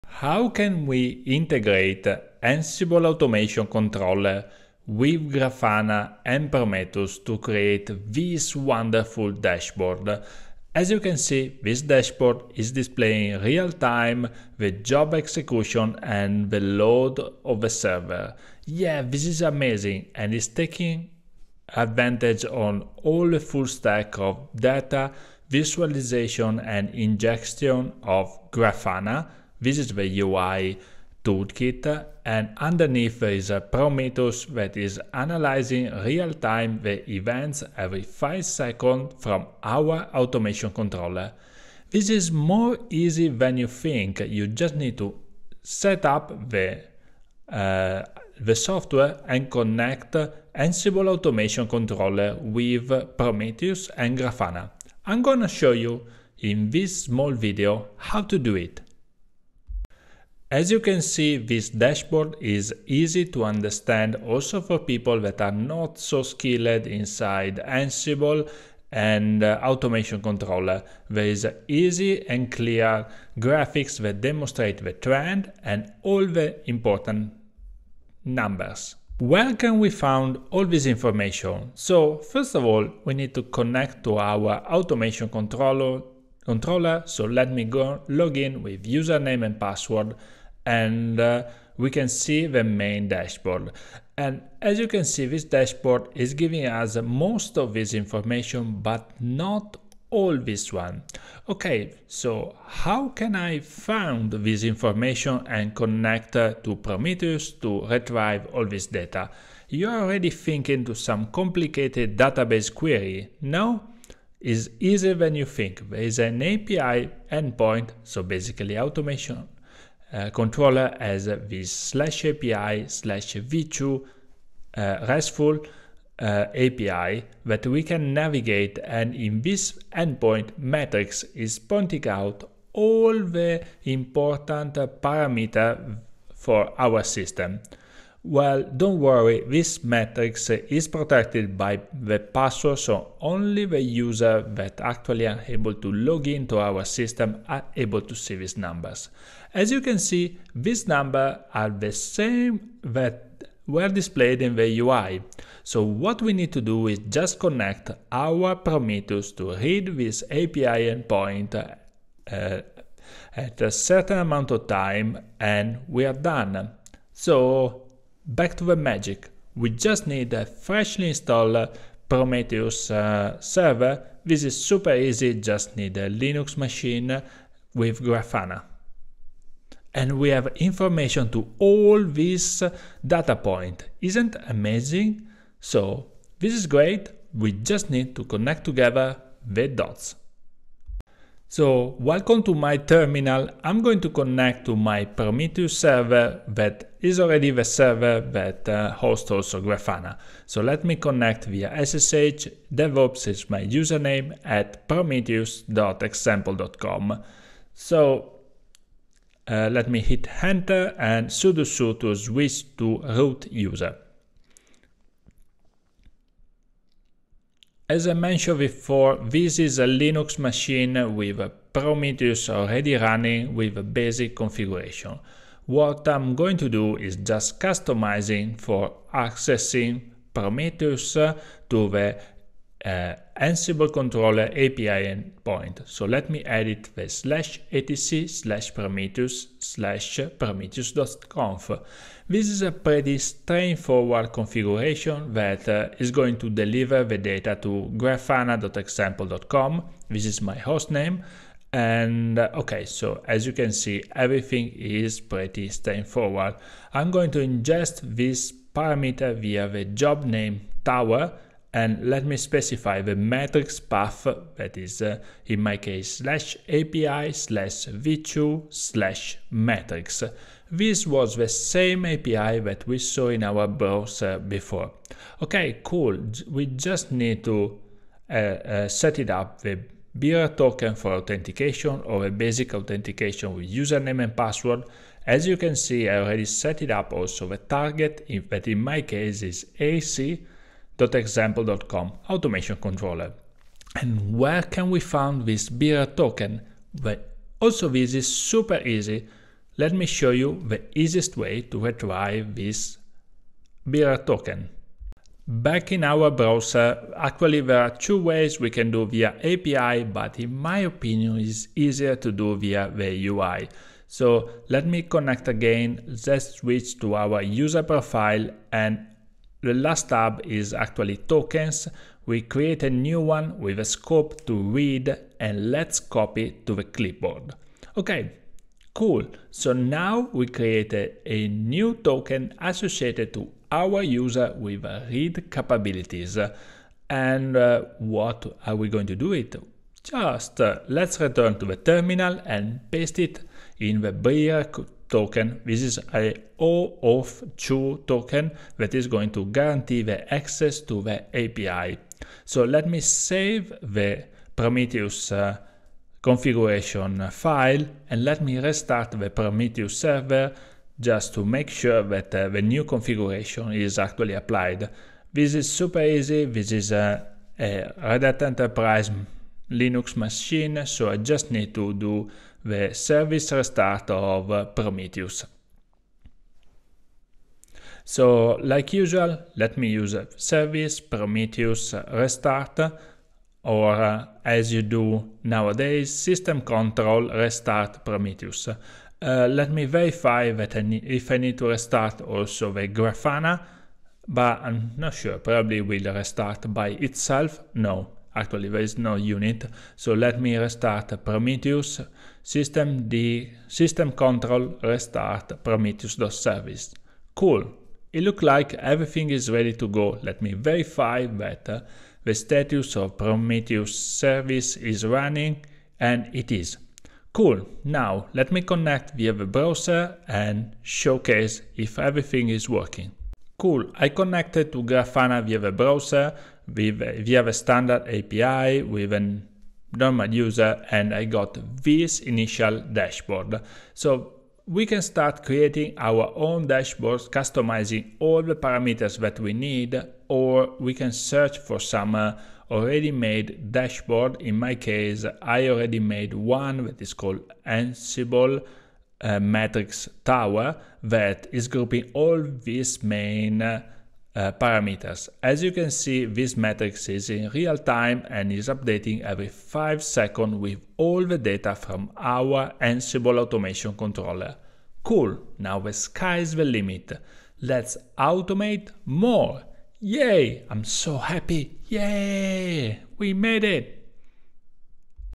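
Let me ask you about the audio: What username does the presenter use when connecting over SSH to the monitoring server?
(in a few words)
DevOps.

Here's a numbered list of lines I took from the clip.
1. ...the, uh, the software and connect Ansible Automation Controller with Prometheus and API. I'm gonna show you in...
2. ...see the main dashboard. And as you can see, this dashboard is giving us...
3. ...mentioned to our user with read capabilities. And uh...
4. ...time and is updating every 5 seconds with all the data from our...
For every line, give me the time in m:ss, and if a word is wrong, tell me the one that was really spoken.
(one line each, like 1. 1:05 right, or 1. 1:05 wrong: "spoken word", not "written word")
1. 0:46 wrong: "Grafana", not "API"
2. 1:32 right
3. 5:32 wrong: "associated", not "mentioned"
4. 7:37 right.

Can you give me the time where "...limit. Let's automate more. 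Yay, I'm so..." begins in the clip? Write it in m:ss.
7:46.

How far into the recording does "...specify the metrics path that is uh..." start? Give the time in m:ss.
4:22.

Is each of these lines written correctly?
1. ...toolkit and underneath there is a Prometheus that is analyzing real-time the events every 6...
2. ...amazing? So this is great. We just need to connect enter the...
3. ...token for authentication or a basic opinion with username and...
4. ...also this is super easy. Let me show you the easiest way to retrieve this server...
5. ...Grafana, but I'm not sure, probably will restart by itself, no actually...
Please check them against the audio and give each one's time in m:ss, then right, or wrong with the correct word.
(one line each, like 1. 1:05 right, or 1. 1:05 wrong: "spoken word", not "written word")
1. 0:31 wrong: "5", not "6"
2. 3:04 wrong: "together", not "enter"
3. 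4:40 wrong: "authentication", not "opinion"
4. 4:57 wrong: "bearer", not "server"
5. 6:32 right.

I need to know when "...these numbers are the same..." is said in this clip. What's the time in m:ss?
2:30.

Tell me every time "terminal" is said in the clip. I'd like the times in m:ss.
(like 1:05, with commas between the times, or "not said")
3:12, 5:41.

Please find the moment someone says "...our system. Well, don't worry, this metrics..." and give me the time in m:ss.
2:16.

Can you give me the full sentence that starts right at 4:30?
This was the same API that we saw in our browser before.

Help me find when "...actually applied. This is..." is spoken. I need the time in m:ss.
6:03.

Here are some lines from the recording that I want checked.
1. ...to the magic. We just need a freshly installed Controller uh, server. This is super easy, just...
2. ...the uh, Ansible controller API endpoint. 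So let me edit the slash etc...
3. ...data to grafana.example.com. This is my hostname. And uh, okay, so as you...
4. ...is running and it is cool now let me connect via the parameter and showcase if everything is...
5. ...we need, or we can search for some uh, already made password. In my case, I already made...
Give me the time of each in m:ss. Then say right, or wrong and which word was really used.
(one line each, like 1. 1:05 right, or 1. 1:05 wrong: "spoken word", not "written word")
1. 2:48 wrong: "Prometheus", not "Controller"
2. 3:51 right
3. 4:07 right
4. 6:54 wrong: "browser", not "parameter"
5. 7:19 wrong: "dashboard", not "password".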